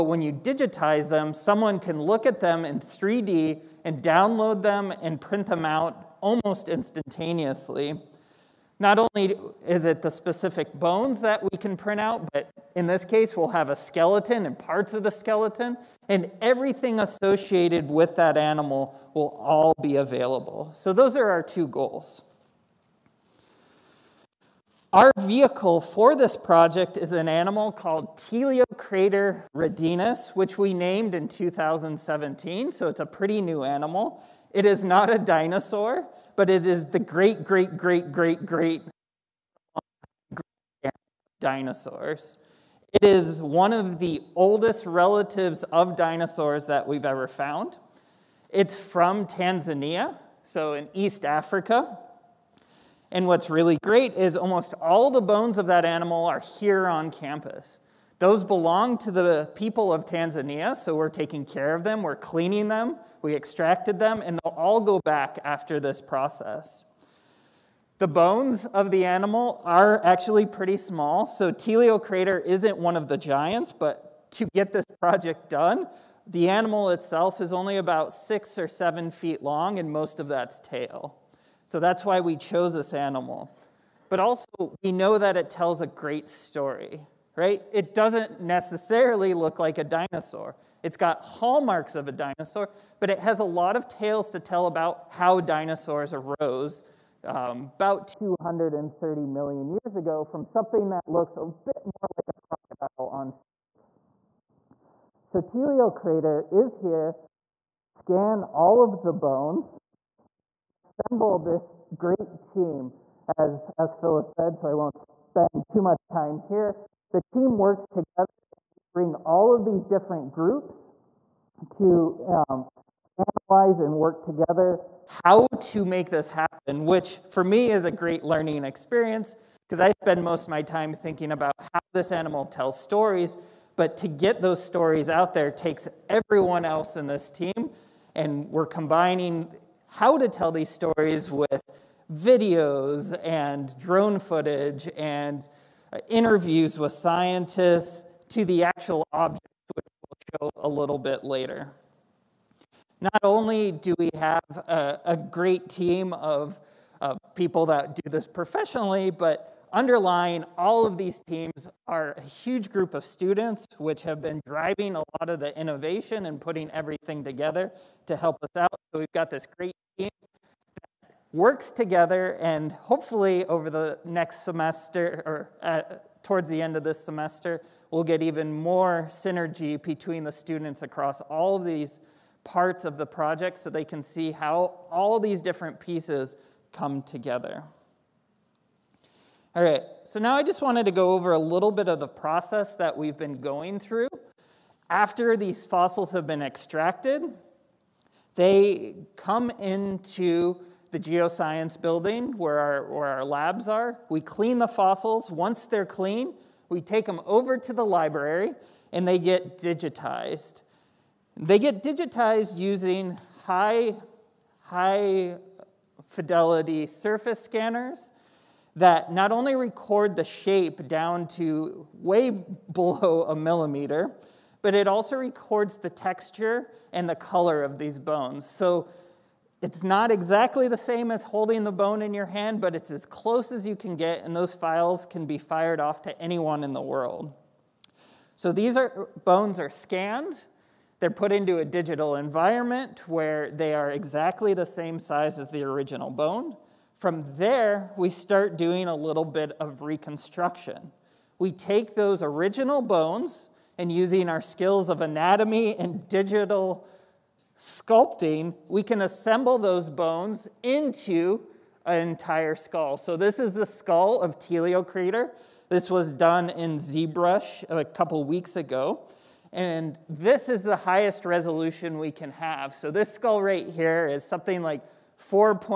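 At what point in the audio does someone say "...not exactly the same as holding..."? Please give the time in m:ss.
3:49.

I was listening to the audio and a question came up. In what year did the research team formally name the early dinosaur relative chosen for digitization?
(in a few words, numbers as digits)
2017.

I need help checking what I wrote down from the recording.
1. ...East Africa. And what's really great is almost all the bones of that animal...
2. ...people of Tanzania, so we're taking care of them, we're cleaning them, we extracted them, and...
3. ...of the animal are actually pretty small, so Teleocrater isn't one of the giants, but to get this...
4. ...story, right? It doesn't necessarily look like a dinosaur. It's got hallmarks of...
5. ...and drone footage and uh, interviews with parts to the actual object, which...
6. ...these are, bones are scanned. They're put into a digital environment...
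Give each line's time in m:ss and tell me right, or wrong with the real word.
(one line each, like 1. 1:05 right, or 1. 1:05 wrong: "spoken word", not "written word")
1. 0:50 right
2. 0:59 right
3. 1:08 right
4. 1:26 right
5. 2:23 wrong: "scientists", not "parts"
6. 3:58 right.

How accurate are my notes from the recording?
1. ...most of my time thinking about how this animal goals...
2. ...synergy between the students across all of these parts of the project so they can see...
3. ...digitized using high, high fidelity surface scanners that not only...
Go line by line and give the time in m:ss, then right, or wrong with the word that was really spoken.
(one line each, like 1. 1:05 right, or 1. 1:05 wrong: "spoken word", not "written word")
1. 2:10 wrong: "tells", not "goals"
2. 2:59 right
3. 3:31 right.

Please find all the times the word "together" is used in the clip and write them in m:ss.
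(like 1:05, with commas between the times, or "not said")
1:57, 2:04, 2:47, 2:51, 3:07.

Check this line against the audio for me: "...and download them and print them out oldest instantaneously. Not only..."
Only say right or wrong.
wrong.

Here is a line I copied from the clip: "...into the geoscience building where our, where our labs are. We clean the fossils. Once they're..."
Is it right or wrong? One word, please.
right.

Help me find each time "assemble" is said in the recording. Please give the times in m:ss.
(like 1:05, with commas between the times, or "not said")
1:50, 4:19.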